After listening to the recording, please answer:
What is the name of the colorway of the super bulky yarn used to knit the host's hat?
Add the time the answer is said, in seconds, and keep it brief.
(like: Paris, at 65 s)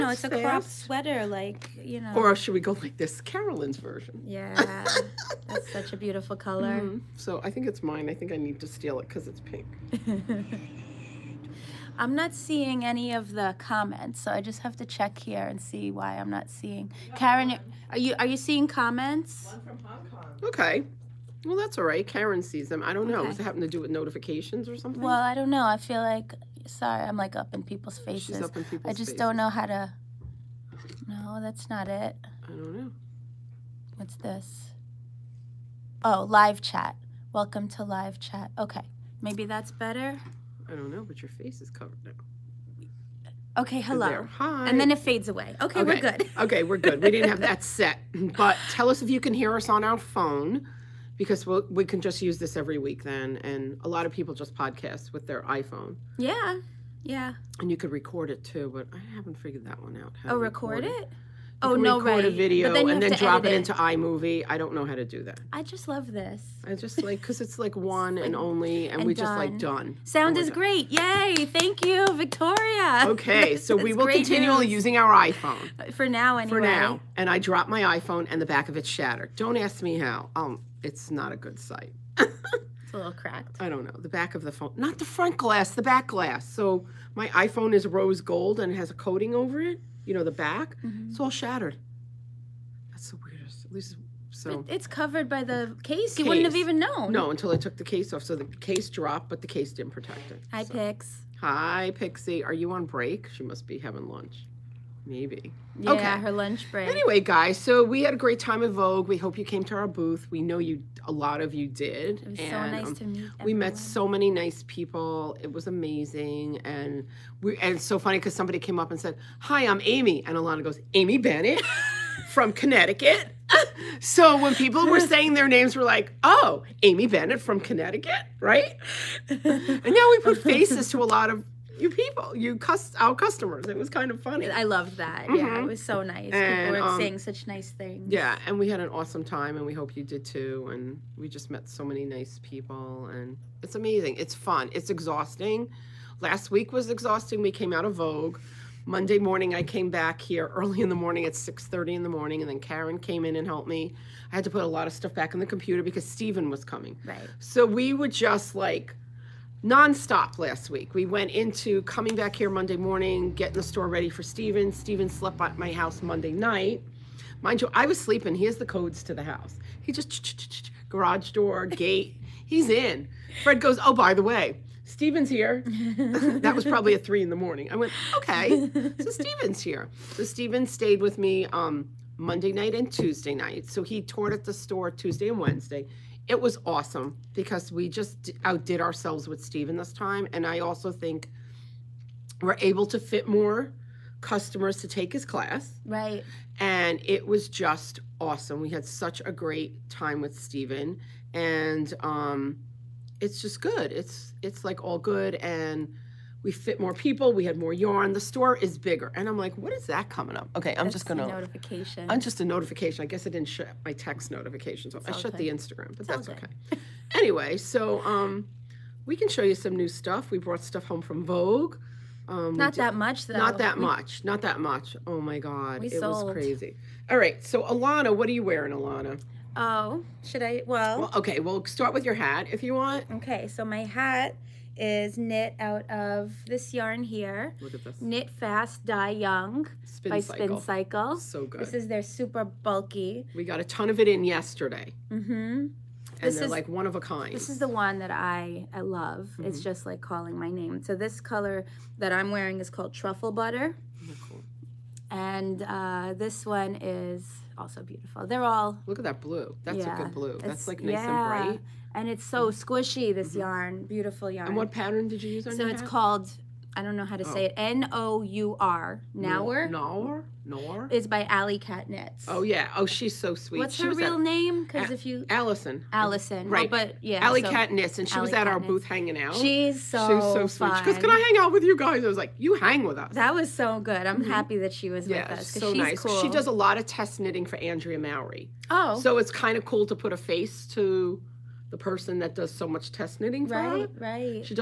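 Truffle Butter, at 252 s.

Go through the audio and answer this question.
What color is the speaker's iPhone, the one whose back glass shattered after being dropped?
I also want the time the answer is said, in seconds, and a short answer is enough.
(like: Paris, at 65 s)
Rose gold, at 87 s.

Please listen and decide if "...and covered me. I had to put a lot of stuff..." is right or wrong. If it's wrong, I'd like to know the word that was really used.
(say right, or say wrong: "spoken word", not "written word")
wrong: "helped", not "covered".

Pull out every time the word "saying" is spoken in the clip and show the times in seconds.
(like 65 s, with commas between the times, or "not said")
124 s, 136 s.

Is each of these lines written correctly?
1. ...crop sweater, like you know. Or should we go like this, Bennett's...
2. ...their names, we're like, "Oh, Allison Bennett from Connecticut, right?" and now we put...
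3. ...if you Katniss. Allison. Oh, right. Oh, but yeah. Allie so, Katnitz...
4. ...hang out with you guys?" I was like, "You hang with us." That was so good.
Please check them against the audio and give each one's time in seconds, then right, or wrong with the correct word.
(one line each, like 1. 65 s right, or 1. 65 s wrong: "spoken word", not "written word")
1. 0 s wrong: "Carolyn", not "Bennett"
2. 125 s wrong: "Amy", not "Allison"
3. 274 s wrong: "Allison", not "Katniss"
4. 281 s right.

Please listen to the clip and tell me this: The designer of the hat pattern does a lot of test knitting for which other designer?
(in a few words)
Andrea Mowry.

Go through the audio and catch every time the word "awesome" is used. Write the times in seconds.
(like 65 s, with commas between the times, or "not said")
138 s, 186 s, 198 s.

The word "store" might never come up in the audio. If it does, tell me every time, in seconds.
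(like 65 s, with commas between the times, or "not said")
163 s, 184 s, 208 s.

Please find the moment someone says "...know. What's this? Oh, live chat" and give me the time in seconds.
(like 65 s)
32 s.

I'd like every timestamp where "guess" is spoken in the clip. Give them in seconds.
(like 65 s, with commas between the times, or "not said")
213 s.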